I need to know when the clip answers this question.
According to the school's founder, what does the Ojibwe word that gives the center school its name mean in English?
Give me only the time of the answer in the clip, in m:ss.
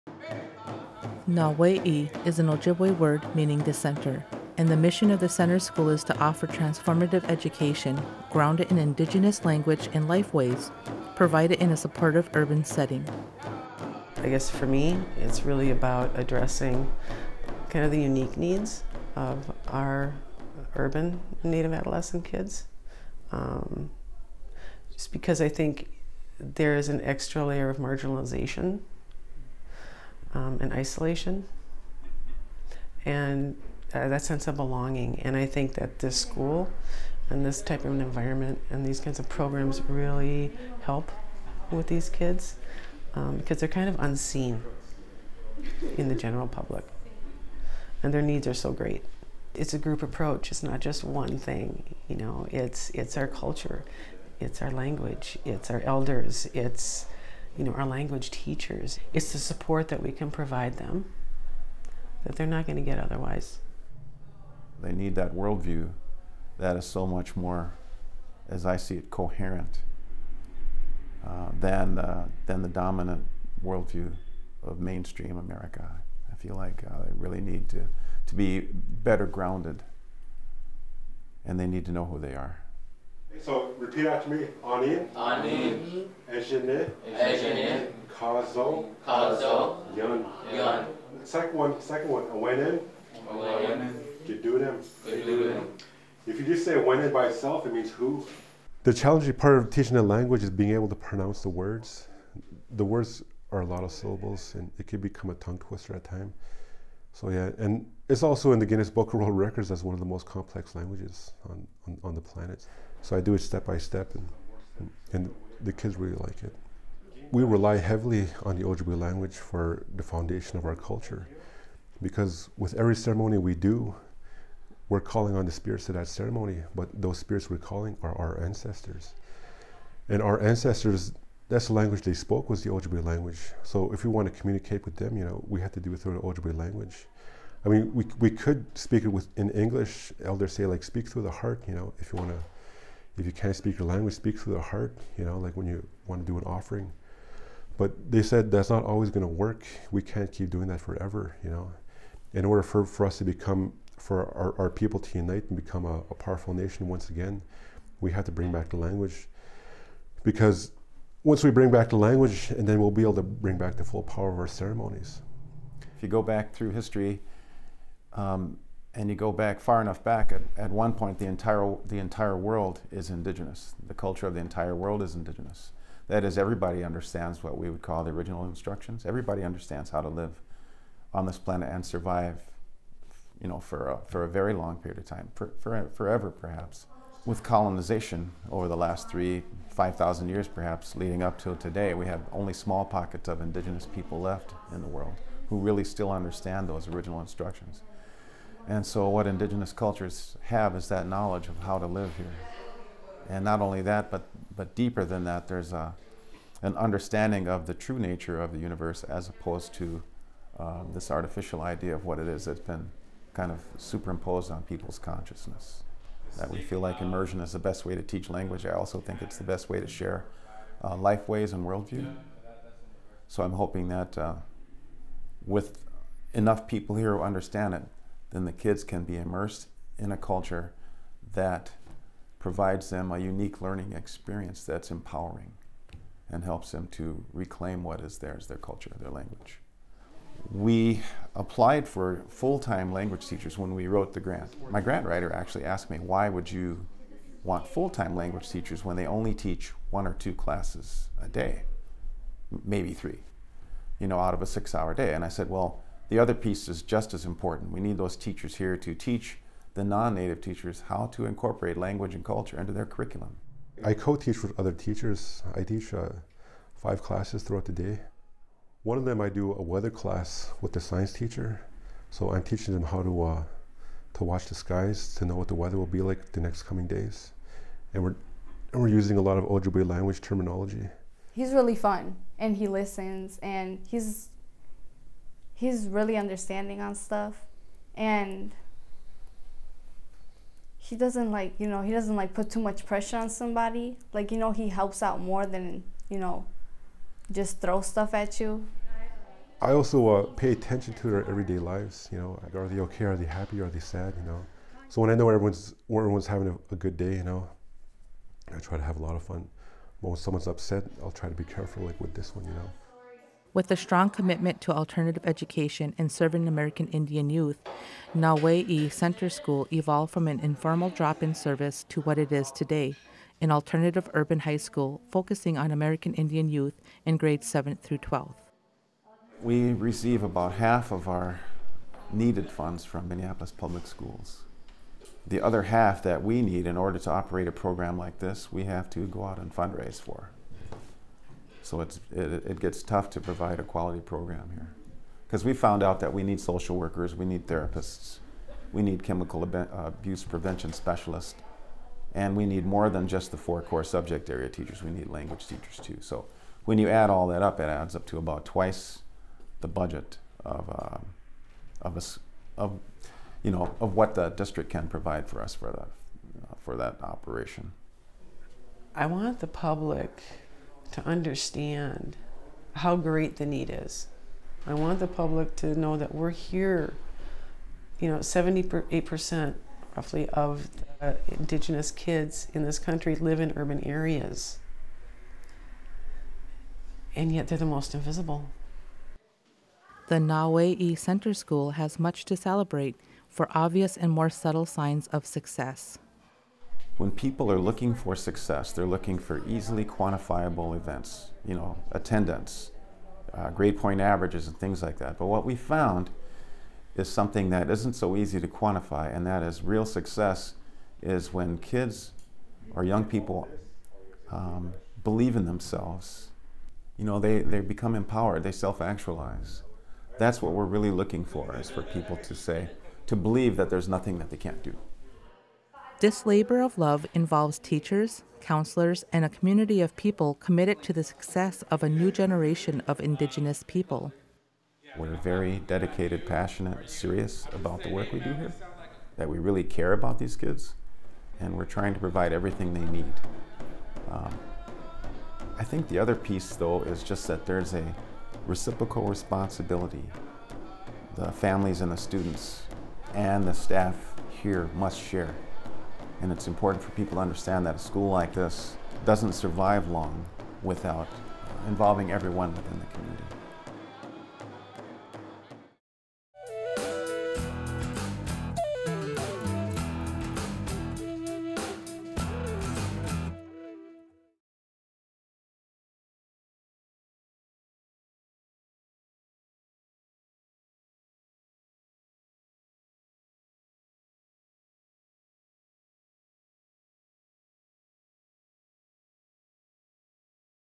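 0:03.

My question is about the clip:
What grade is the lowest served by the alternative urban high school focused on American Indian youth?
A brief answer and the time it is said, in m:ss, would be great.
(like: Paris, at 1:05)
7th, at 5:27.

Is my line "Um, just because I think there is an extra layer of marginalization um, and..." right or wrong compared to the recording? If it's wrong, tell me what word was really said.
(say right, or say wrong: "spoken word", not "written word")
right.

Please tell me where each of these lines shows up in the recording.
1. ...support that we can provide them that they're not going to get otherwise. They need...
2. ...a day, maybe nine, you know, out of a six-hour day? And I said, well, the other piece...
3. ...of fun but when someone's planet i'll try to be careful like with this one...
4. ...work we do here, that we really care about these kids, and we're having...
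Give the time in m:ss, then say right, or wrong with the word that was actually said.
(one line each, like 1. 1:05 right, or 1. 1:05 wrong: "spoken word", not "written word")
1. 0:59 right
2. 4:11 wrong: "three", not "nine"
3. 5:09 wrong: "upset", not "planet"
4. 7:17 wrong: "trying", not "having".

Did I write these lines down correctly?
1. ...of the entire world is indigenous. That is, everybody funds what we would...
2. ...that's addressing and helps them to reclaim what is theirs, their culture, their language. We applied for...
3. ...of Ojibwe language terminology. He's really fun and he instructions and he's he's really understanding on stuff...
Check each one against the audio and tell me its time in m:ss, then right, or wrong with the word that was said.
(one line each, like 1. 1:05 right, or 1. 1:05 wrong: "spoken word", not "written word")
1. 2:54 wrong: "understands", not "funds"
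2. 3:54 wrong: "empowering", not "addressing"
3. 4:39 wrong: "listens", not "instructions".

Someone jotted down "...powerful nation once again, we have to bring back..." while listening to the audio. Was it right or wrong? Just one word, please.
right.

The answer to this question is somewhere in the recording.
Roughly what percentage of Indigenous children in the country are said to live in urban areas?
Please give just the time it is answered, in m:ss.
6:18.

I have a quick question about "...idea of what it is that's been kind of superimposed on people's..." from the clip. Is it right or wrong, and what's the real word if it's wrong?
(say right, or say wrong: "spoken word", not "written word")
right.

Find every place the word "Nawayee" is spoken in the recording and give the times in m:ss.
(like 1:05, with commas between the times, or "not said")
0:01, 5:18, 6:30.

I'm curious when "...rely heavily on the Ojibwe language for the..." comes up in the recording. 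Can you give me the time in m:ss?
1:57.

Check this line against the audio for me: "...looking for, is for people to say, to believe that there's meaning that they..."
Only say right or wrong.
wrong.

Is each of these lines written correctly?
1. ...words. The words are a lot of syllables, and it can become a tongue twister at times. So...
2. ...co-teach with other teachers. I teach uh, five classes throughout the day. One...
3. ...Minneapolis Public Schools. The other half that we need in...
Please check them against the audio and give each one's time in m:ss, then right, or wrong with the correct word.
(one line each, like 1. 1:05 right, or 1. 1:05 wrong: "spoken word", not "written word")
1. 1:41 right
2. 4:23 right
3. 5:33 right.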